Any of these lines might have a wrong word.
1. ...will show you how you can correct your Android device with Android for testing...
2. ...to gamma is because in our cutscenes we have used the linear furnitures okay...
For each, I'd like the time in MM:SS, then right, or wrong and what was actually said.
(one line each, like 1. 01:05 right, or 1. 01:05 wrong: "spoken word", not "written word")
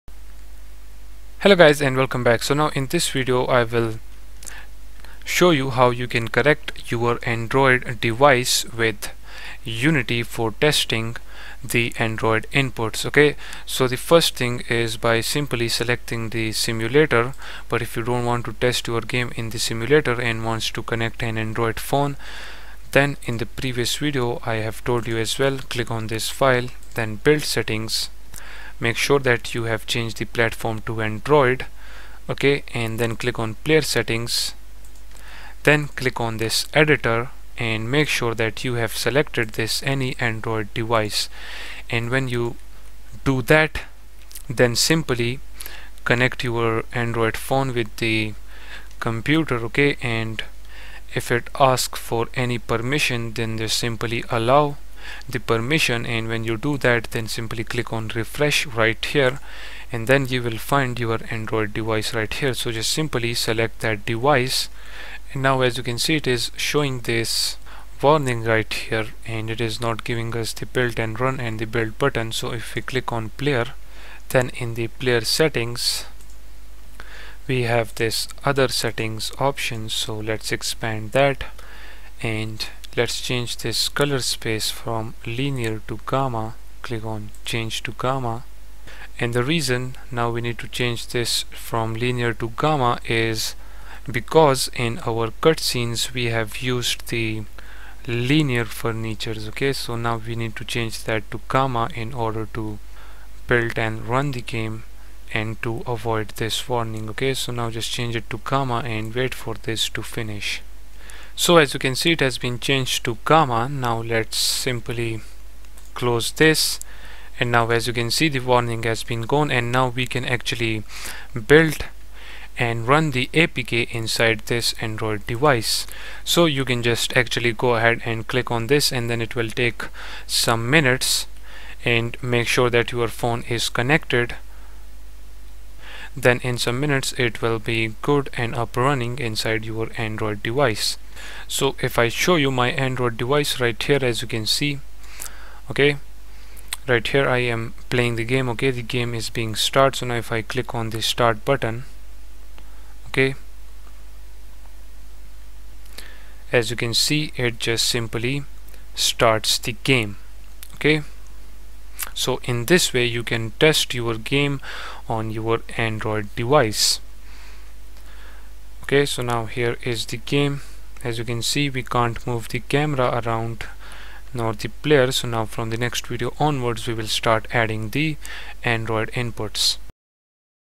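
1. 00:03 wrong: "Unity", not "Android"
2. 01:32 right.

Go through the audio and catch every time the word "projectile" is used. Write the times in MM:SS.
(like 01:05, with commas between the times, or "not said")
not said.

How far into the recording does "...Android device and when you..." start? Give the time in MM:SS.
00:40.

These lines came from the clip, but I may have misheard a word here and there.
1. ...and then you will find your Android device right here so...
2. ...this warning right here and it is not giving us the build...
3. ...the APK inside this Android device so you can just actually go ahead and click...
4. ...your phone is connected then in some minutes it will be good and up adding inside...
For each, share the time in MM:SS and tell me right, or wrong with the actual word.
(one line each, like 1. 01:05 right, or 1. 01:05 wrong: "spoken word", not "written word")
1. 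00:59 right
2. 01:07 right
3. 02:03 right
4. 02:12 wrong: "running", not "adding".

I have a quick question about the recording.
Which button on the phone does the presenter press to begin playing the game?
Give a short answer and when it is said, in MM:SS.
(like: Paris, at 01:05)
Start button, at 02:31.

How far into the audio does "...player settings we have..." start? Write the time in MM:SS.
01:14.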